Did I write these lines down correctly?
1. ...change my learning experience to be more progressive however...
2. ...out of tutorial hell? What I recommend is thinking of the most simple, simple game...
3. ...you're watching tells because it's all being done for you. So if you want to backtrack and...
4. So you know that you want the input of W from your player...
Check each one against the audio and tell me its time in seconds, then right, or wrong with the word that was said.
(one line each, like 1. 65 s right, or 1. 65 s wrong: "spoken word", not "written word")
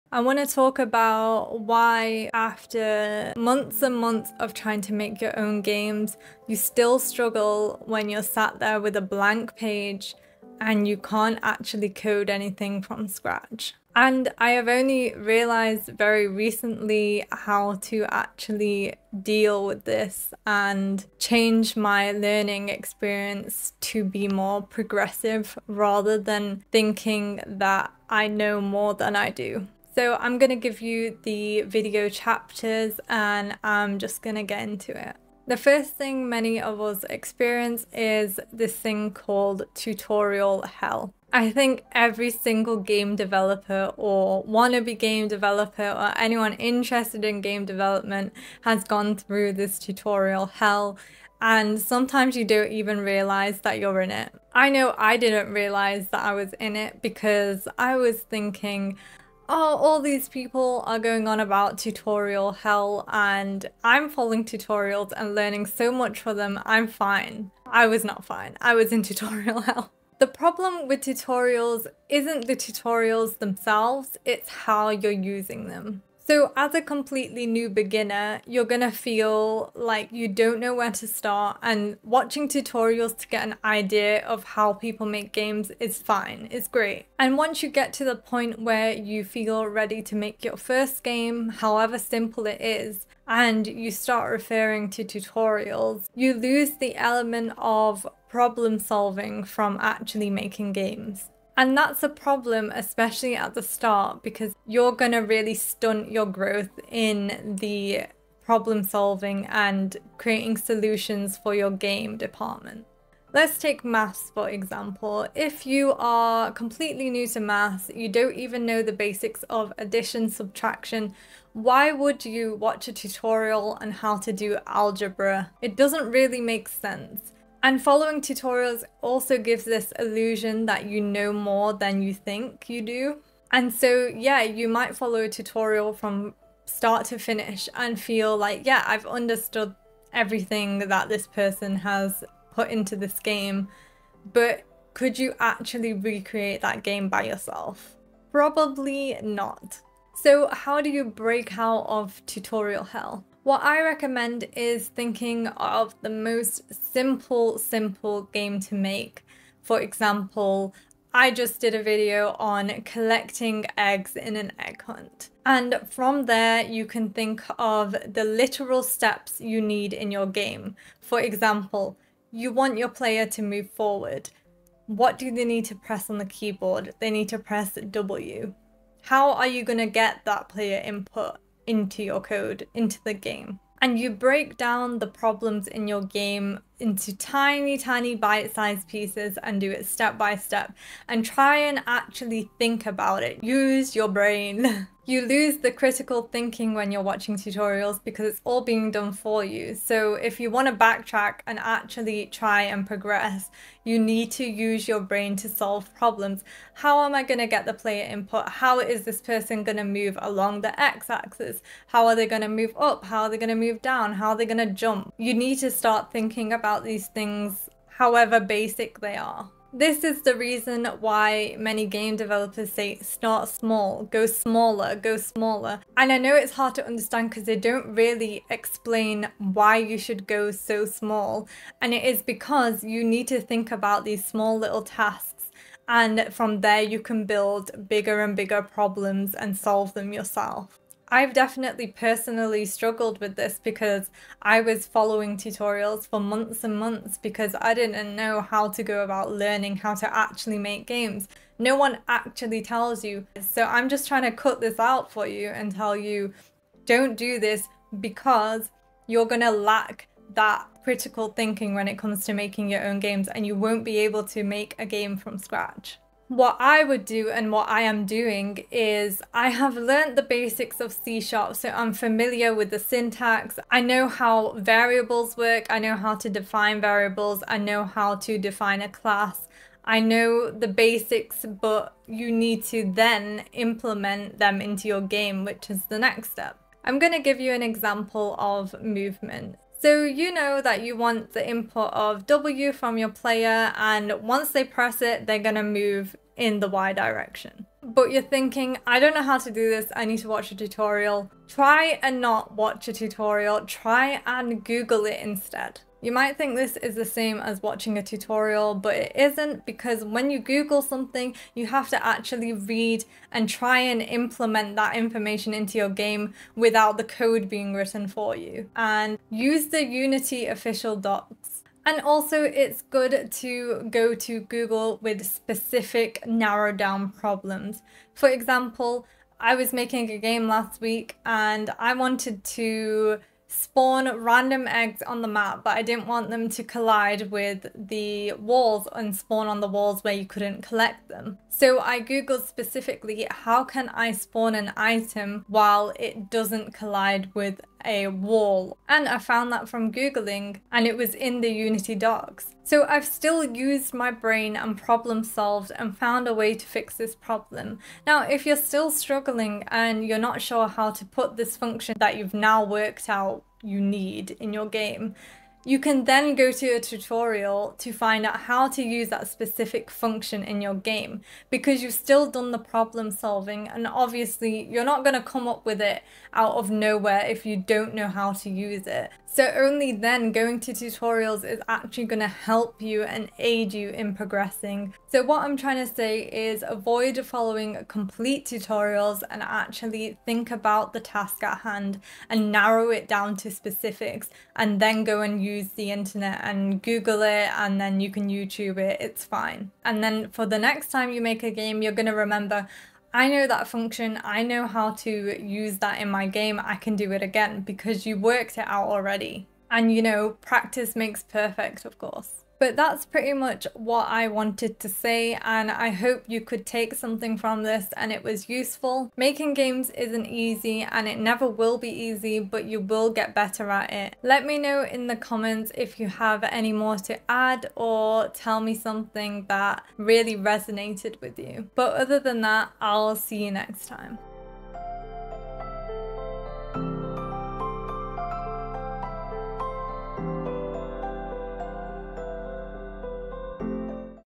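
1. 21 s wrong: "rather", not "however"
2. 151 s right
3. 196 s wrong: "tutorials", not "tells"
4. 289 s right.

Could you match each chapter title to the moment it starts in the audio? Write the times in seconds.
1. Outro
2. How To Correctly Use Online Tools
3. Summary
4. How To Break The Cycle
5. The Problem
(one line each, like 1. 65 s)
1. 412 s
2. 286 s
3. 384 s
4. 150 s
5. 35 s.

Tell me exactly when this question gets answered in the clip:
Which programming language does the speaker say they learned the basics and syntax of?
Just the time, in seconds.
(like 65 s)
270 s.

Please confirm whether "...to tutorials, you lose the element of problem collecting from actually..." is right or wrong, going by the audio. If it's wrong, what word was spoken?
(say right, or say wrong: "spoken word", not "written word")
wrong: "solving", not "collecting".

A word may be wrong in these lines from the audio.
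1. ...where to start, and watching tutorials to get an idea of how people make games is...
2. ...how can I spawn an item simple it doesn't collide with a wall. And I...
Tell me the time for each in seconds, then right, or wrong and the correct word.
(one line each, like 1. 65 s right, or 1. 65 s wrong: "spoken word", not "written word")
1. 80 s right
2. 343 s wrong: "while", not "simple".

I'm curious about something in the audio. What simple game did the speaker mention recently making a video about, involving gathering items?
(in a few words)
Egg hunt.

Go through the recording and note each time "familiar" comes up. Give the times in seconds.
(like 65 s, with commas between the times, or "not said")
271 s.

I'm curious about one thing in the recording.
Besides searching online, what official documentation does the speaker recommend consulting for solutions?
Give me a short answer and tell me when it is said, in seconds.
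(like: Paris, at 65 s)
Unity docs, at 319 s.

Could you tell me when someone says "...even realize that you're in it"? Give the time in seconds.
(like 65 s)
52 s.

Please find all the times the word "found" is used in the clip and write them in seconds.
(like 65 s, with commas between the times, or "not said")
349 s, 355 s.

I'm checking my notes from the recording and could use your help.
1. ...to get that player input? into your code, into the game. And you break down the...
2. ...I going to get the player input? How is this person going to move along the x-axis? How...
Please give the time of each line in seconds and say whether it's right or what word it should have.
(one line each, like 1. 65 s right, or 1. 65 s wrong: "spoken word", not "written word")
1. 179 s right
2. 207 s right.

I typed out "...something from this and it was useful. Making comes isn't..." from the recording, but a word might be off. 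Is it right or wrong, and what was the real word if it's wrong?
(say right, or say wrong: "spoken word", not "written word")
wrong: "games", not "comes".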